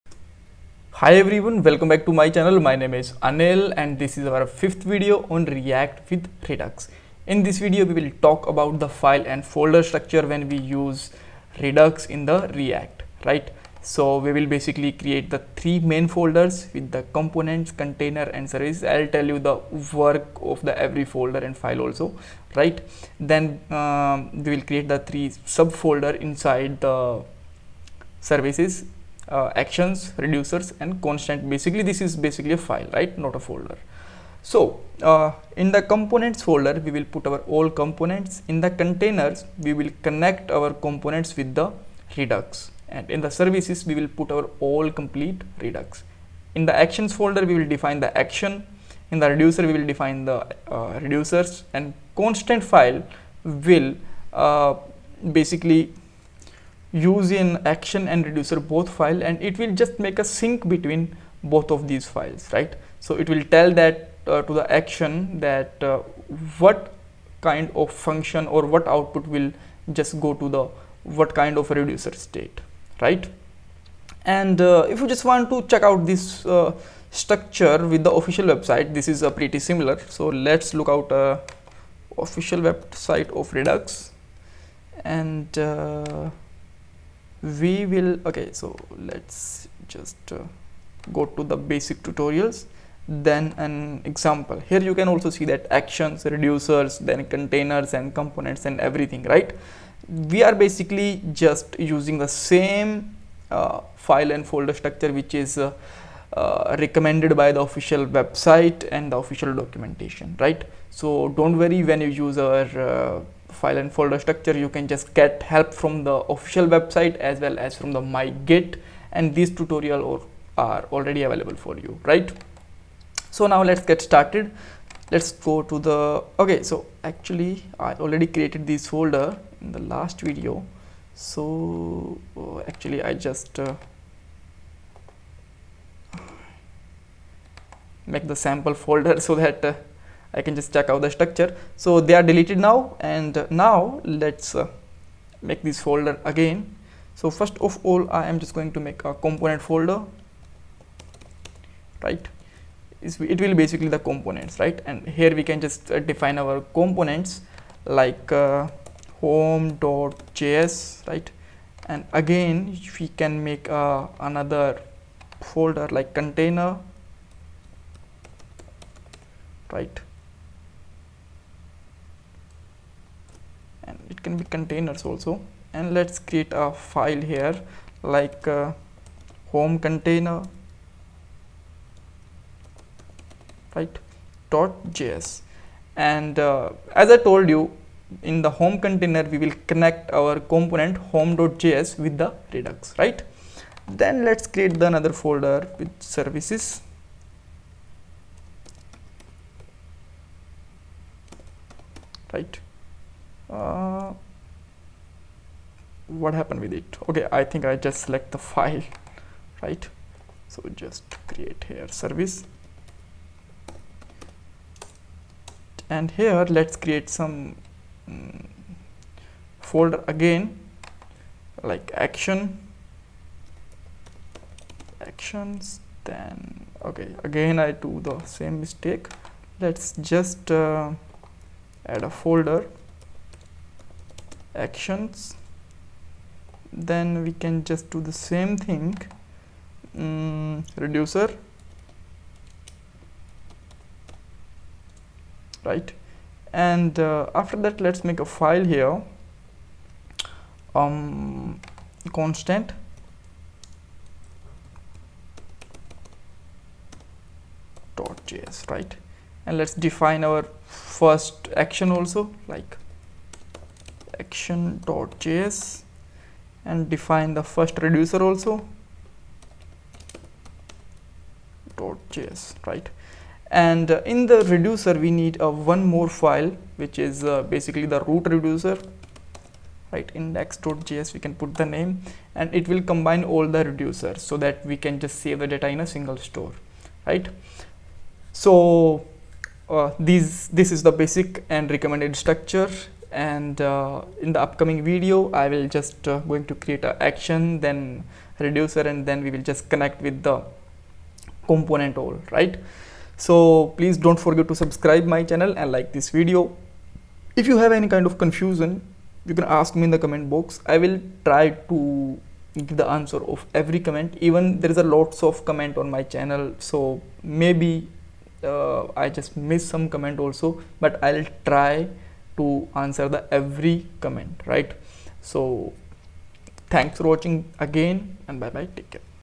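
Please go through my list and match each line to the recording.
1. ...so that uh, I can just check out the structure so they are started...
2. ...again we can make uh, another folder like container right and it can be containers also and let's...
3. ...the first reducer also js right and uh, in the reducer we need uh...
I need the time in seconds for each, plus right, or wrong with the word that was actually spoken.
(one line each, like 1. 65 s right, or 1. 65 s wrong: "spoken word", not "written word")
1. 139 s wrong: "deleted", not "started"
2. 162 s right
3. 267 s right.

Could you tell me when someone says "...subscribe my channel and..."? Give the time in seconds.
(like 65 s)
304 s.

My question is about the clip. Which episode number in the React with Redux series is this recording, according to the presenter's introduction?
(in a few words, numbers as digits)
5th.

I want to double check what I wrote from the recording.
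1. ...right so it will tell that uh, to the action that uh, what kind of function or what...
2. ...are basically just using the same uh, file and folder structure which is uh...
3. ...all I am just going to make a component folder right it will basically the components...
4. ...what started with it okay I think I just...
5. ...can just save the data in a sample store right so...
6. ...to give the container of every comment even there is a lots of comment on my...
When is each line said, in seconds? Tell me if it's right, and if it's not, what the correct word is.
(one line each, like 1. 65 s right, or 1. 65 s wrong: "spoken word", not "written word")
1. 62 s right
2. 100 s right
3. 147 s right
4. 206 s wrong: "happened", not "started"
5. 284 s wrong: "single", not "sample"
6. 311 s wrong: "answer", not "container".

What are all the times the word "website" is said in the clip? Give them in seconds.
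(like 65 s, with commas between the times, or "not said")
78 s, 82 s, 108 s, 116 s.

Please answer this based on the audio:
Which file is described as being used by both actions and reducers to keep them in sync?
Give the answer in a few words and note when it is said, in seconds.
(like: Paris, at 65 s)
constant file, at 52 s.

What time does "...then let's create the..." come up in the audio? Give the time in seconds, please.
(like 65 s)
194 s.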